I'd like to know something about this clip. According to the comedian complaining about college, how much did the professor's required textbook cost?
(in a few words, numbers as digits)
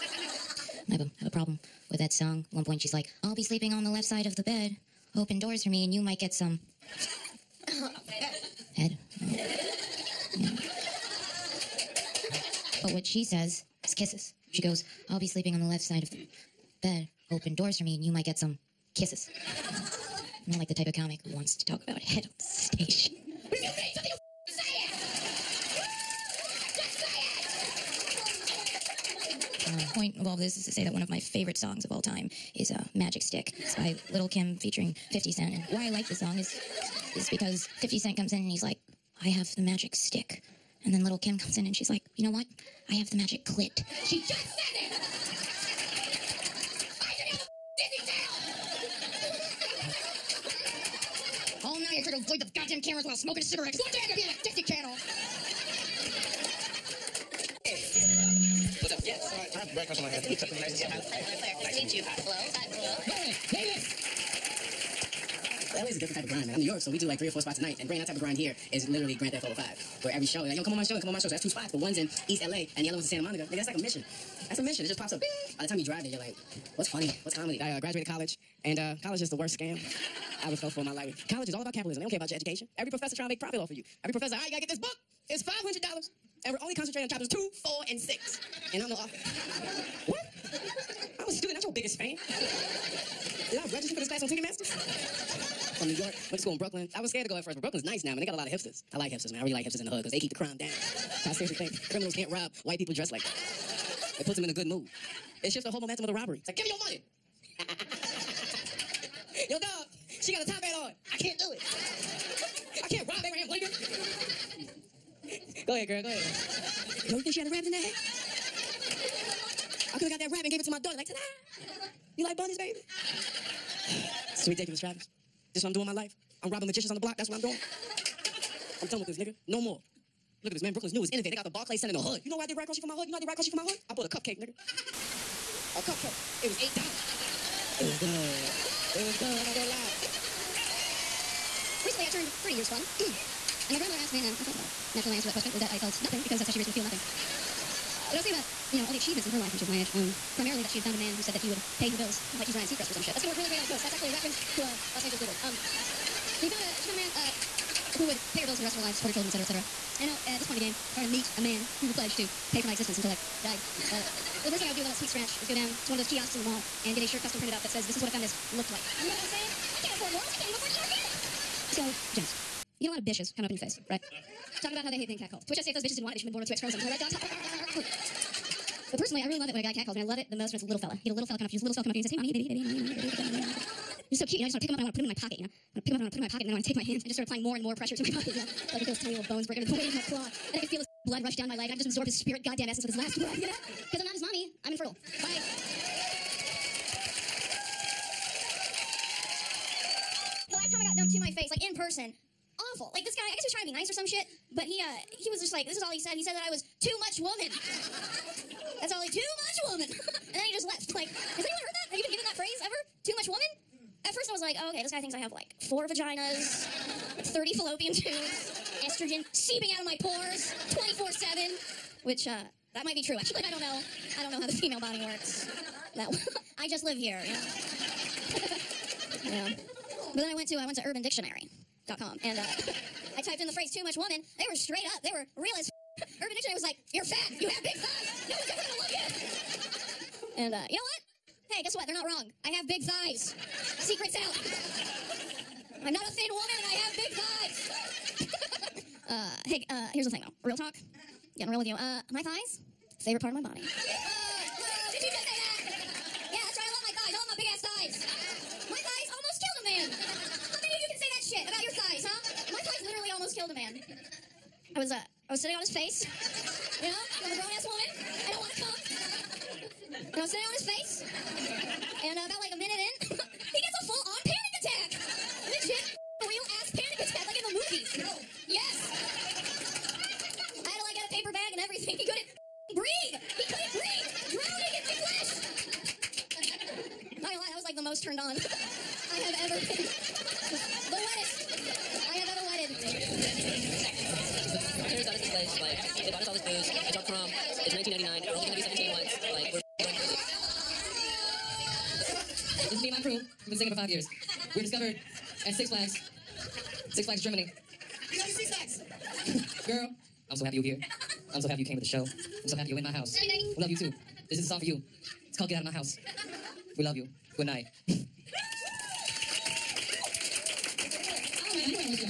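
$500.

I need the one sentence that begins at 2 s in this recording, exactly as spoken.
At one point, she's like, I'll be sleeping on the left side of the bed.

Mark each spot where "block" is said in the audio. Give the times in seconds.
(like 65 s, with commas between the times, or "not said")
126 s.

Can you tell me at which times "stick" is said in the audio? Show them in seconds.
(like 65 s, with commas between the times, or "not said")
33 s, 39 s.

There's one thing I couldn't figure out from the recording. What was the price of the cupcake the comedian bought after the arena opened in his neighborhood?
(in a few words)
$8.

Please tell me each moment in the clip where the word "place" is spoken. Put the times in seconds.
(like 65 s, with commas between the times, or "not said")
295 s.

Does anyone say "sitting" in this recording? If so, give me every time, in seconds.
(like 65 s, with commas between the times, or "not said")
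265 s, 270 s.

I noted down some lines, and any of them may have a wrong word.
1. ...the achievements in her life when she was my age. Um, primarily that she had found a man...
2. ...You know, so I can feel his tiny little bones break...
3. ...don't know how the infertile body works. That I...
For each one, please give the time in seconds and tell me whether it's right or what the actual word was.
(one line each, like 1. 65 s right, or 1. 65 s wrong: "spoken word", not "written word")
1. 148 s right
2. 188 s right
3. 224 s wrong: "female", not "infertile".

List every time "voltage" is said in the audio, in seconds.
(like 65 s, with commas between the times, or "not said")
not said.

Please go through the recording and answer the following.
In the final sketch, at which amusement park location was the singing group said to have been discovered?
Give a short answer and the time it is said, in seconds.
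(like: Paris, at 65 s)
Six Flags Germany, at 306 s.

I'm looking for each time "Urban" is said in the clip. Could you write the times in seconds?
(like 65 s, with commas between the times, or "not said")
230 s, 235 s.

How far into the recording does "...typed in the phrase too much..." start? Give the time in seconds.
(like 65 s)
233 s.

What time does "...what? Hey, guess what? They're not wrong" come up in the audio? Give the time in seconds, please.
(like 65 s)
240 s.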